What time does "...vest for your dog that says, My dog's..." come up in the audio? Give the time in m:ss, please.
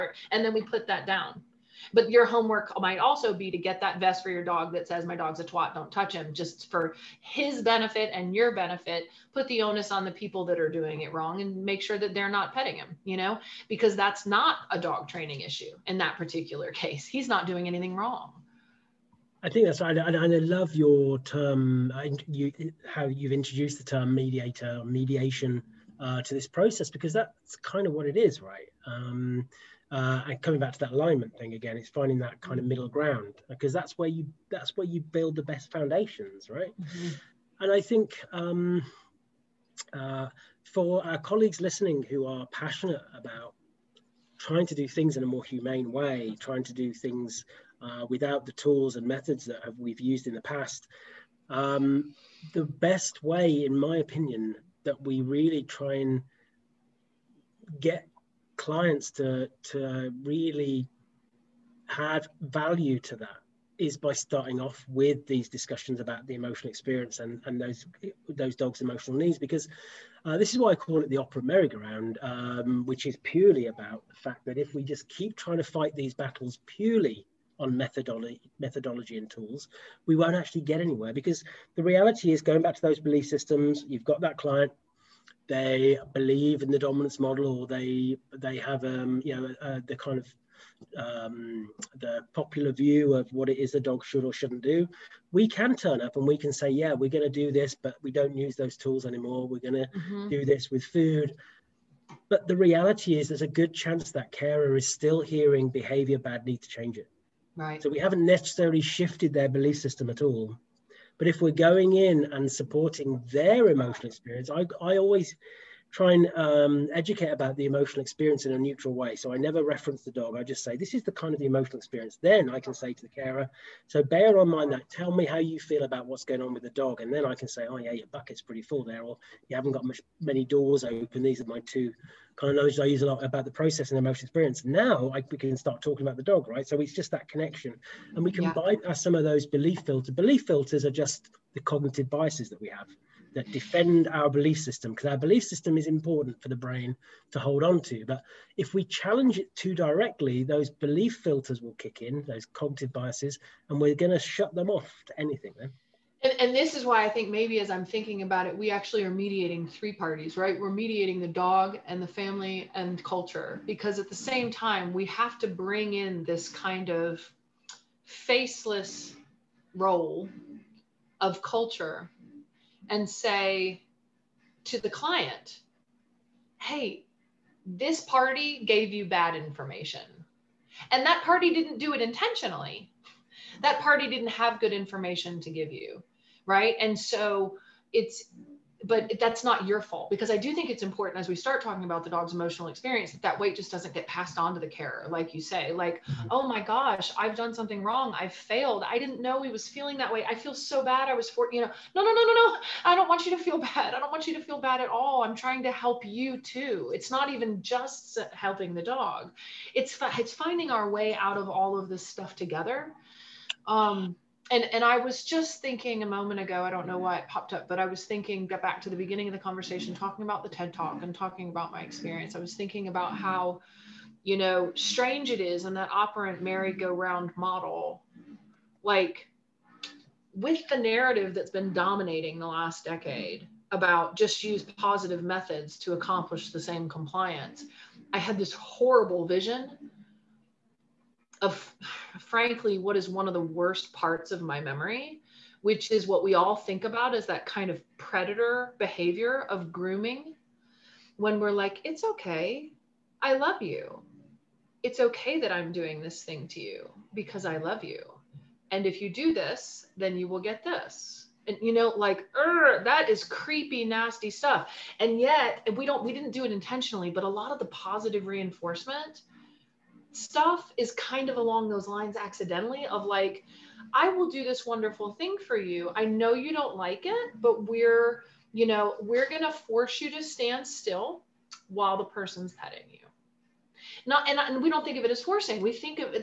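0:03.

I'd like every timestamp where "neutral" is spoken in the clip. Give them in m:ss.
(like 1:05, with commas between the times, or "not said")
1:58.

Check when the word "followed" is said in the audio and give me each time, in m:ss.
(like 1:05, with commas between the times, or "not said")
not said.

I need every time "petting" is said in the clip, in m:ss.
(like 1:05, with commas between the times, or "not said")
0:12, 4:42.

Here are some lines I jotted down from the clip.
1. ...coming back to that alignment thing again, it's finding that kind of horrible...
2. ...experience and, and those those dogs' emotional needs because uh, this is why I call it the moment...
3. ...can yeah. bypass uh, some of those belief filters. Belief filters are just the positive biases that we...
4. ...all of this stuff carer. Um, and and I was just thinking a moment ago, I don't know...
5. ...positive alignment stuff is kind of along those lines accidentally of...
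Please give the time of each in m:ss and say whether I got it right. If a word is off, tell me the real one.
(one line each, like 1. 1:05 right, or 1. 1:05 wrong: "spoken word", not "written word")
1. 0:30 wrong: "middle", not "horrible"
2. 1:06 wrong: "operant", not "moment"
3. 2:18 wrong: "cognitive", not "positive"
4. 3:31 wrong: "together", not "carer"
5. 4:27 wrong: "reinforcement", not "alignment".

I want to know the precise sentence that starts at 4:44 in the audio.
Not, and, and we don't think of it as forcing.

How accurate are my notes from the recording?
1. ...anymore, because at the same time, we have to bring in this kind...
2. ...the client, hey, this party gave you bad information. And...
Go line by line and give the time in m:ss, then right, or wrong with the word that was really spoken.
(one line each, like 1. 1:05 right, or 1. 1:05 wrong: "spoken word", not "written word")
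1. 2:43 wrong: "culture", not "anymore"
2. 2:54 right.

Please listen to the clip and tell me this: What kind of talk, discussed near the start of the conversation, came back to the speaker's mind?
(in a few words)
TED Talk.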